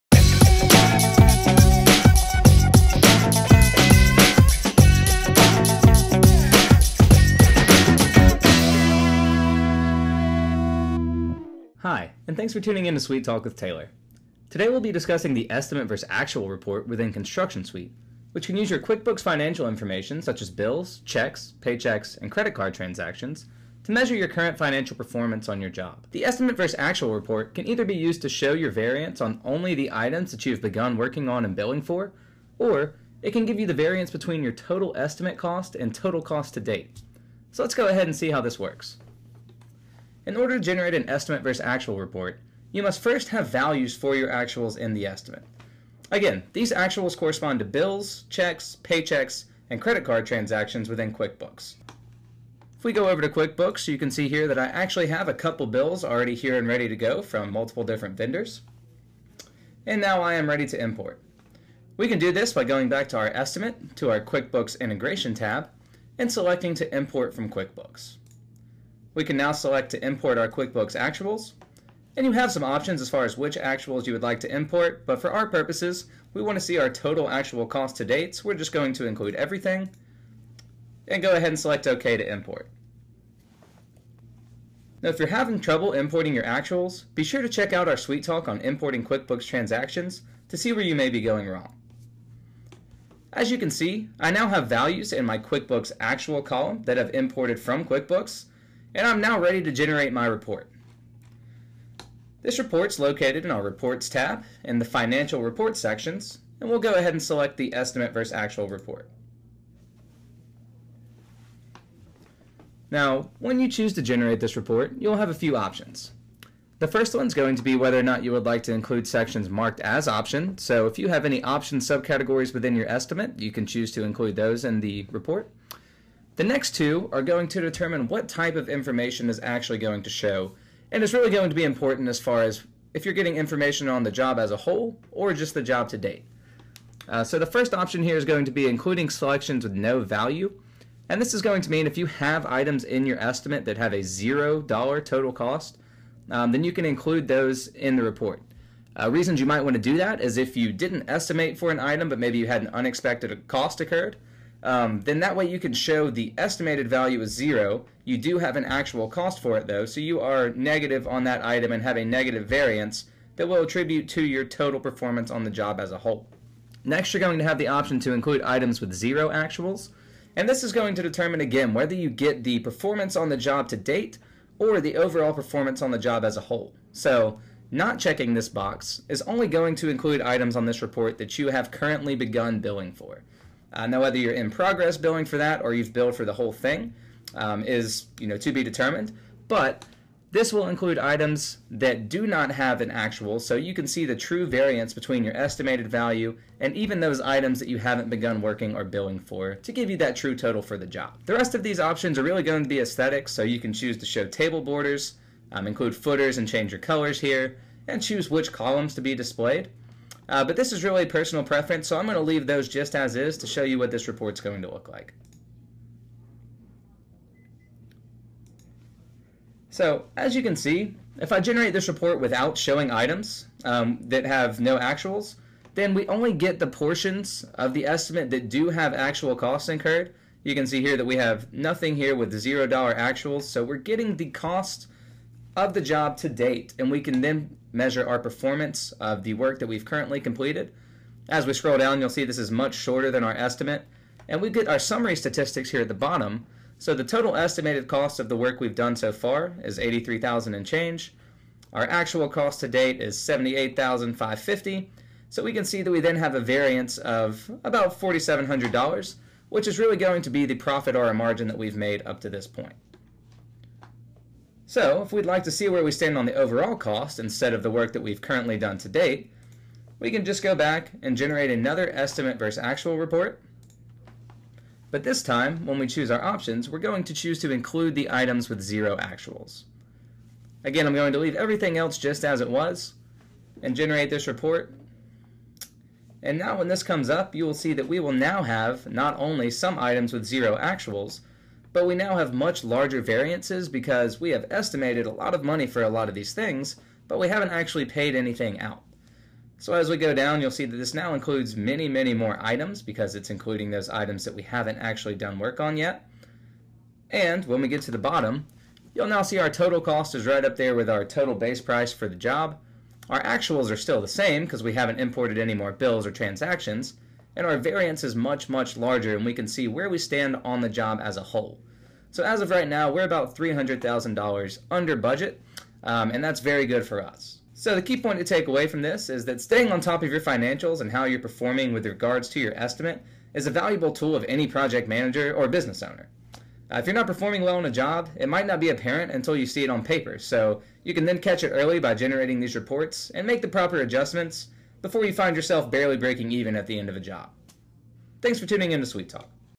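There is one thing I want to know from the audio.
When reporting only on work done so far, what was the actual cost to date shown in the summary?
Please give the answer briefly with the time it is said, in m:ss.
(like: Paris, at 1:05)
78,550, at 4:13.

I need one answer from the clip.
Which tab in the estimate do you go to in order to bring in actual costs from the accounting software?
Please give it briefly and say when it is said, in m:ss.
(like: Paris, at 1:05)
QuickBooks integration tab, at 1:04.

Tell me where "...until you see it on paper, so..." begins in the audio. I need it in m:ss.
5:39.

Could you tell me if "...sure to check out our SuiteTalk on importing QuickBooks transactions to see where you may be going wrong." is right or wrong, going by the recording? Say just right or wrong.
right.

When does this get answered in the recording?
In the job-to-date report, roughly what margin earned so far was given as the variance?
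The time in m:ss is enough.
4:17.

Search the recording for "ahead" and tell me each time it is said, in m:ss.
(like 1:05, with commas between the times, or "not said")
0:37, 1:21, 1:46.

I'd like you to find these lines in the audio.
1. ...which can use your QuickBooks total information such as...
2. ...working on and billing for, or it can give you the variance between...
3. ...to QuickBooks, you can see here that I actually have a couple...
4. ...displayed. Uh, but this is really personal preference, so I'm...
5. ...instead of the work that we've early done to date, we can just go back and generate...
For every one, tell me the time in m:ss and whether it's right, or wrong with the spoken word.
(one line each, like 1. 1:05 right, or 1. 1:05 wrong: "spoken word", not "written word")
1. 0:18 wrong: "financial", not "total"
2. 0:30 right
3. 0:53 right
4. 3:29 right
5. 4:27 wrong: "currently", not "early".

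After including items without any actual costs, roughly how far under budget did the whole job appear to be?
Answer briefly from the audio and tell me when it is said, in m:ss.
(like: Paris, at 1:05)
$300,000, at 5:23.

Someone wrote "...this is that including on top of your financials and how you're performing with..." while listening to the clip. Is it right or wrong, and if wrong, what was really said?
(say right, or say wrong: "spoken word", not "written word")
wrong: "staying", not "including".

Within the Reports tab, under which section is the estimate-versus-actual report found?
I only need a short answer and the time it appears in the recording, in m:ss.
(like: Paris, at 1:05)
Financial Reports, at 1:44.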